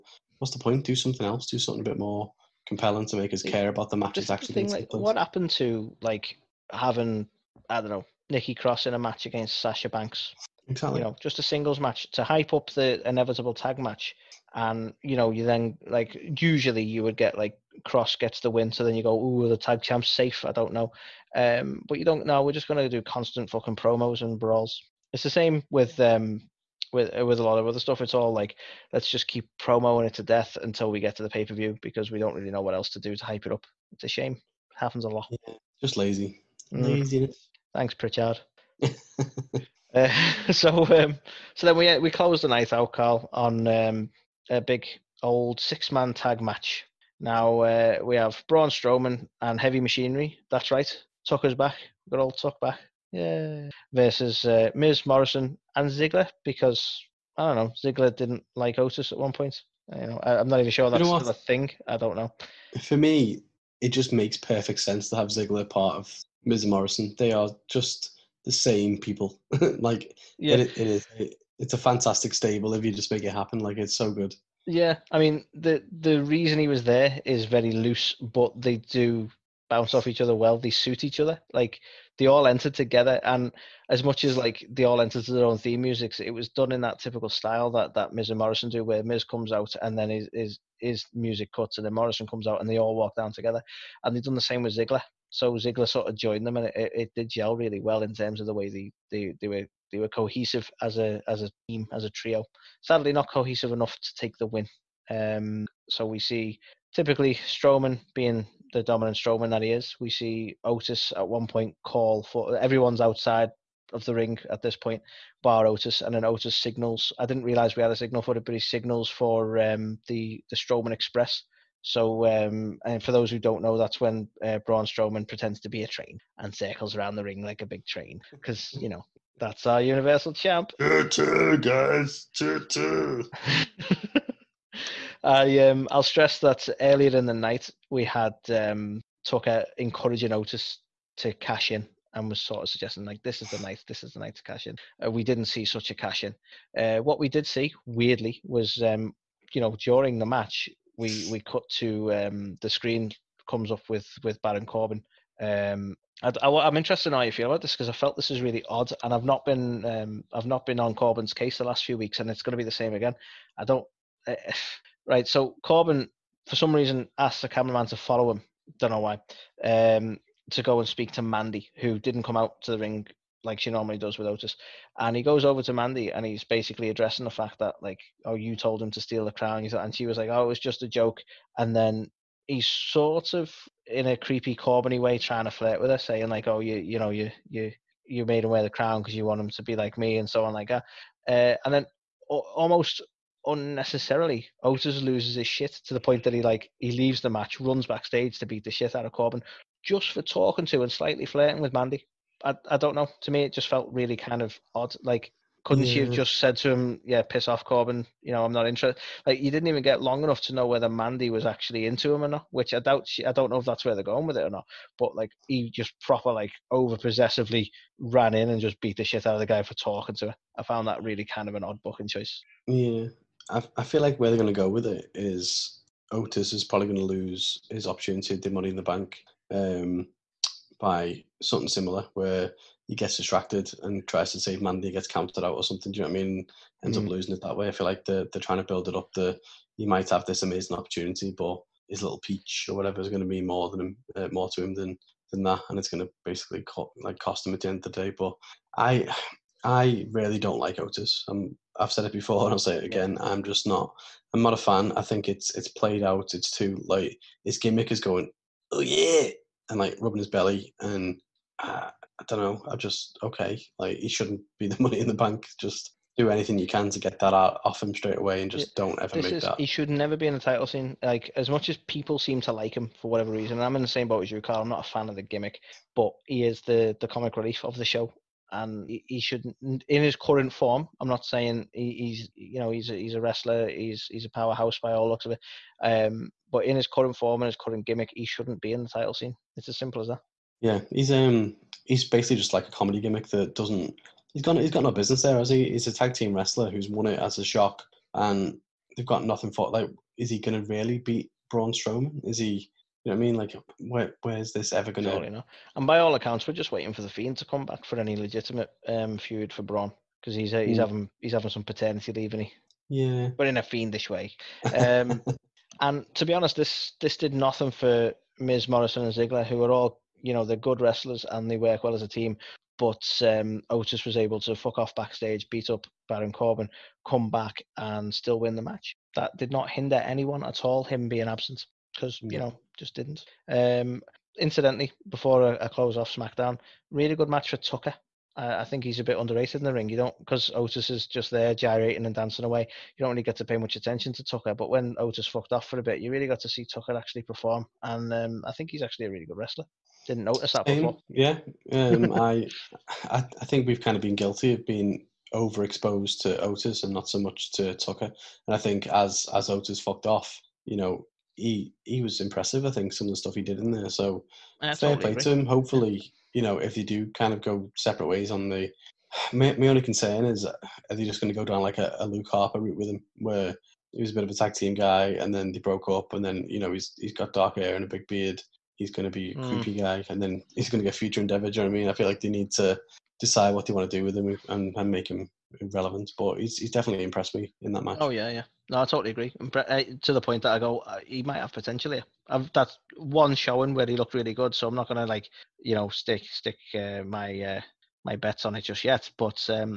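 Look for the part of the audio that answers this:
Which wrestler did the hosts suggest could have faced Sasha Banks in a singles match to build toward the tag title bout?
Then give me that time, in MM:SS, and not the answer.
00:08.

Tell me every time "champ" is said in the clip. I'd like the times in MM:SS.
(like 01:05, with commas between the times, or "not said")
00:19, 02:10.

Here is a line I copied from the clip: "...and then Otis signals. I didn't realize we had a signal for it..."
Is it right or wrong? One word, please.
right.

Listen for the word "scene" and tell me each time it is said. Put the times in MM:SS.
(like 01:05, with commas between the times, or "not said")
04:30, 04:49.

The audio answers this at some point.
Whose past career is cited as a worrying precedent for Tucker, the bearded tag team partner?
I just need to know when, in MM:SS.
06:12.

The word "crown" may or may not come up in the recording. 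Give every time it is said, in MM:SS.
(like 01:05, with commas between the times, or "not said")
02:59, 03:08.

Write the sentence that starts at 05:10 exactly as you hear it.
having he's having some paternity leave, and he yeah, but in a fiendish way.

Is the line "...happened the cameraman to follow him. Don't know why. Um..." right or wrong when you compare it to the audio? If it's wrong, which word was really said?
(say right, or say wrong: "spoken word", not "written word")
wrong: "asked", not "happened".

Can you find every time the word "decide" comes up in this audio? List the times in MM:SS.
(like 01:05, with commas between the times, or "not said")
06:23.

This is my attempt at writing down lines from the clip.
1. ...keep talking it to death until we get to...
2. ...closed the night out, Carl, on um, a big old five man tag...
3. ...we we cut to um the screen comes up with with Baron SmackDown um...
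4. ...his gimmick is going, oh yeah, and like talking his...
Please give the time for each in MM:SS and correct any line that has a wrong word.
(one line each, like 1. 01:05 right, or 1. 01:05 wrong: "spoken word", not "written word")
1. 00:29 wrong: "promoing", not "talking"
2. 00:42 wrong: "six", not "five"
3. 02:30 wrong: "Corbin", not "SmackDown"
4. 04:17 wrong: "rubbing", not "talking".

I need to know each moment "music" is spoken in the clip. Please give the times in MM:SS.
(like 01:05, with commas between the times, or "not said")
01:25, 01:31.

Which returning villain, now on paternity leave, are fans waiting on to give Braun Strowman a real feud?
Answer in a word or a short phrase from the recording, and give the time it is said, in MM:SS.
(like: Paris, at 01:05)
The Fiend, at 05:07.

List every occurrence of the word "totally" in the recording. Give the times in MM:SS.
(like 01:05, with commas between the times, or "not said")
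06:04, 06:28.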